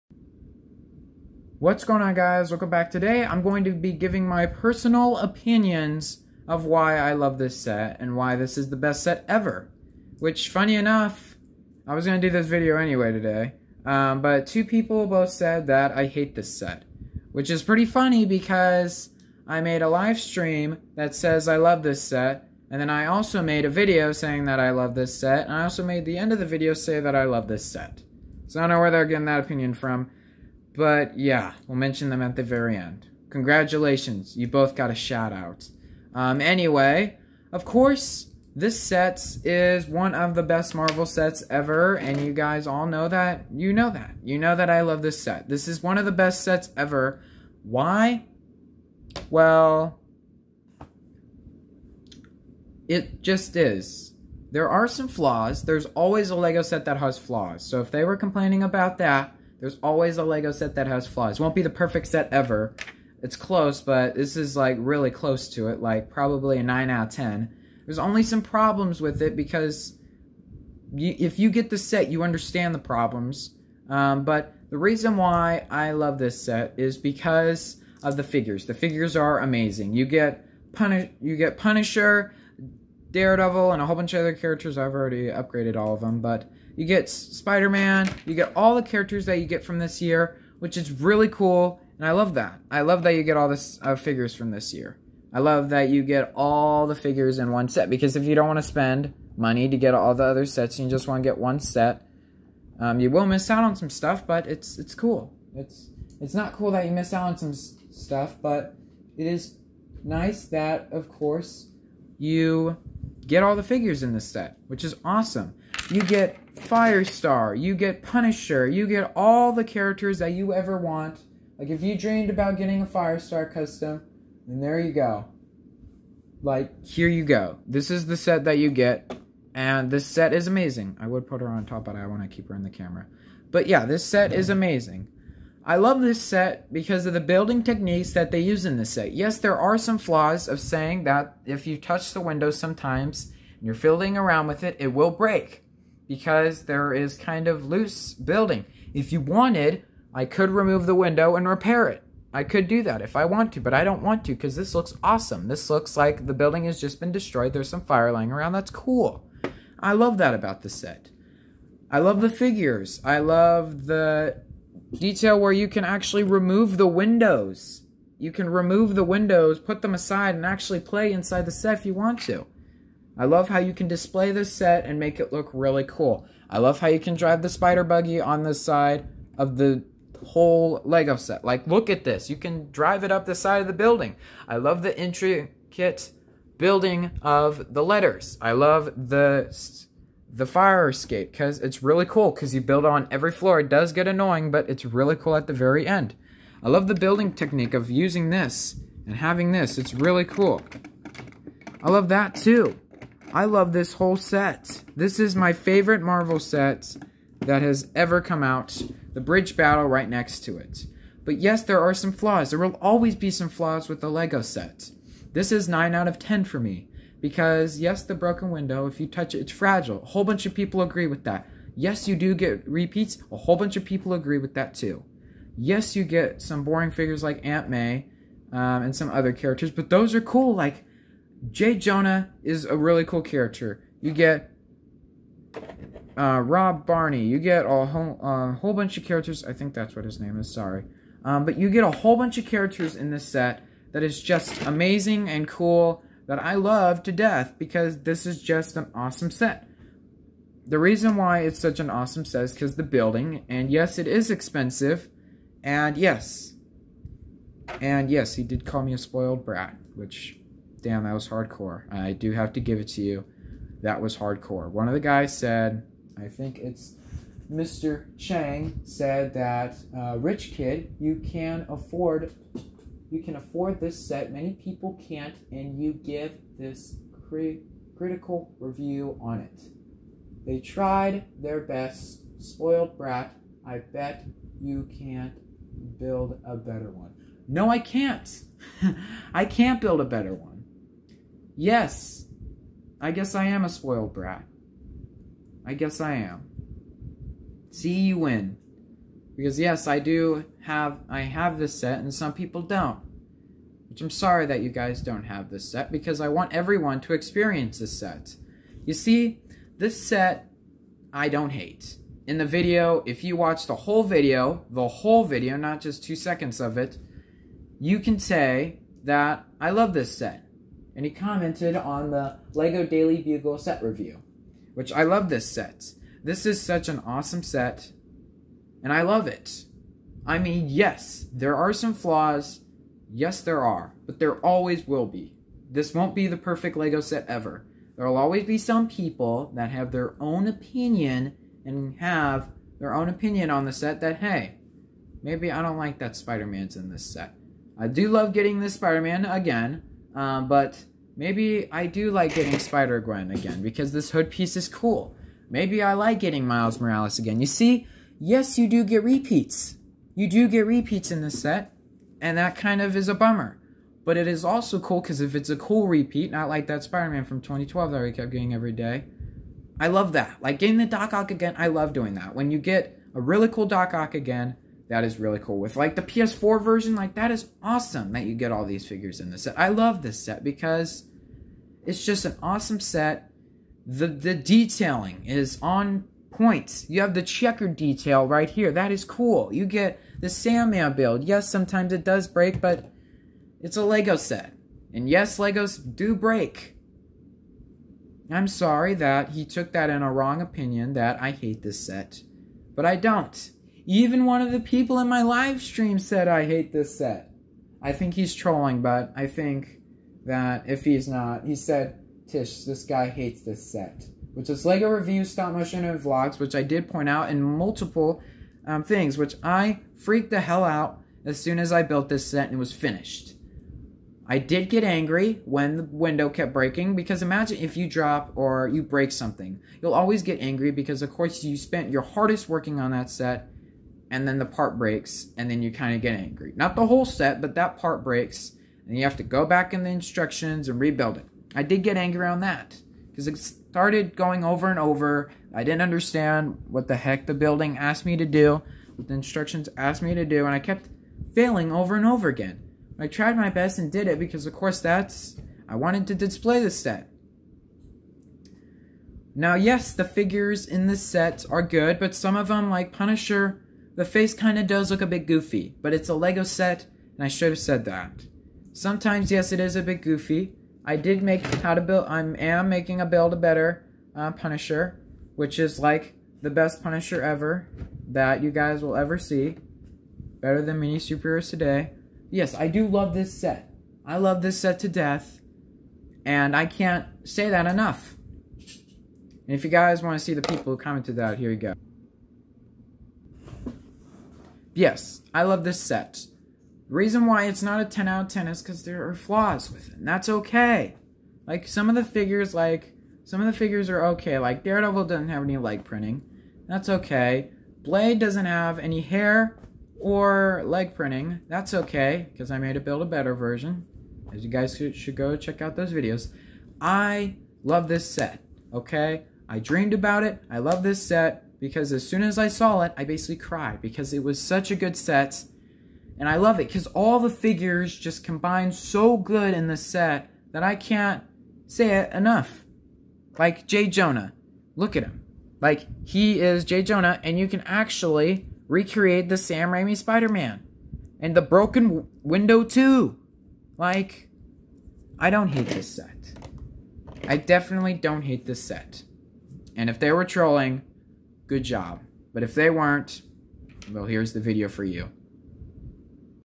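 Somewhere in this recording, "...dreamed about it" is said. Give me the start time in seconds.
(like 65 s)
519 s.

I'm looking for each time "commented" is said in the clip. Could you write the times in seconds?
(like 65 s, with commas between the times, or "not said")
321 s, 490 s.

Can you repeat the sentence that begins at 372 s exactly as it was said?
When you get a really cool Doc Ock again, that is really cool.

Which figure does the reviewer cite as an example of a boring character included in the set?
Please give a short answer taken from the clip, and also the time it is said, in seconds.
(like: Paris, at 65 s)
Aunt May, at 227 s.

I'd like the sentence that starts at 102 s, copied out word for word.
Um, you will miss out on some stuff, but it's it's cool.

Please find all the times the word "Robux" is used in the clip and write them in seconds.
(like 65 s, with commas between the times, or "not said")
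not said.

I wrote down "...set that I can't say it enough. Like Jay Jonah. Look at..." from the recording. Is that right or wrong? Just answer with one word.
right.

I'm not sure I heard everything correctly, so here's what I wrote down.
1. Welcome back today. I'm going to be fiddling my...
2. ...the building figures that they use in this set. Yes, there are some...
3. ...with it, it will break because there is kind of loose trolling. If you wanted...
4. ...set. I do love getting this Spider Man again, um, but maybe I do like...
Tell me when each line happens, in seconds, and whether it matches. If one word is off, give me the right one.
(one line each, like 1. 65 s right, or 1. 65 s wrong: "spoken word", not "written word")
1. 2 s wrong: "giving", not "fiddling"
2. 137 s wrong: "techniques", not "figures"
3. 144 s wrong: "building", not "trolling"
4. 347 s right.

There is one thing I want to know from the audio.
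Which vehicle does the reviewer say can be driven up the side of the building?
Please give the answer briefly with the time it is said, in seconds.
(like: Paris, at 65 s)
Spider buggy, at 177 s.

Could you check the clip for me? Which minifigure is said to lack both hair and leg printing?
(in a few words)
Blade.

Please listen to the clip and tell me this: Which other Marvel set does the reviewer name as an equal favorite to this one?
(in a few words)
The bridge battle.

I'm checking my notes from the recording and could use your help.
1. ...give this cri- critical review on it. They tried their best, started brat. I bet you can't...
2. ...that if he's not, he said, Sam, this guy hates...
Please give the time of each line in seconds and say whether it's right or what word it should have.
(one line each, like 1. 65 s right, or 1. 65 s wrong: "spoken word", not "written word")
1. 275 s wrong: "spoiled", not "started"
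2. 410 s wrong: "Tish", not "Sam".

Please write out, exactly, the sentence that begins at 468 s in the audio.
Sometimes, yes, it is a bit goofy.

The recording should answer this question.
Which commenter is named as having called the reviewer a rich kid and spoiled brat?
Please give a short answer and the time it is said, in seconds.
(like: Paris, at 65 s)
Mr. Chang, at 267 s.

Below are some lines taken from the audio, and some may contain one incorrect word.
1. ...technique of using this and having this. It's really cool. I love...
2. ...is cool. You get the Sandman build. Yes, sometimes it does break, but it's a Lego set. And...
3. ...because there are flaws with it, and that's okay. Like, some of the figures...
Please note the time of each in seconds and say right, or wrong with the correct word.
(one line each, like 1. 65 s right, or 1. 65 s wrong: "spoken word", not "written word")
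1. 197 s right
2. 388 s right
3. 498 s right.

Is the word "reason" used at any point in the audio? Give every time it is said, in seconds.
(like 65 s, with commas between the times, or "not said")
74 s, 250 s, 496 s.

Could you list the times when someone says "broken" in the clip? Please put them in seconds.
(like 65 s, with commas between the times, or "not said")
218 s, 541 s.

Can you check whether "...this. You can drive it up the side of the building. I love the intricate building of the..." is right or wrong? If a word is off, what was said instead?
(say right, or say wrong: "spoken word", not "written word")
right.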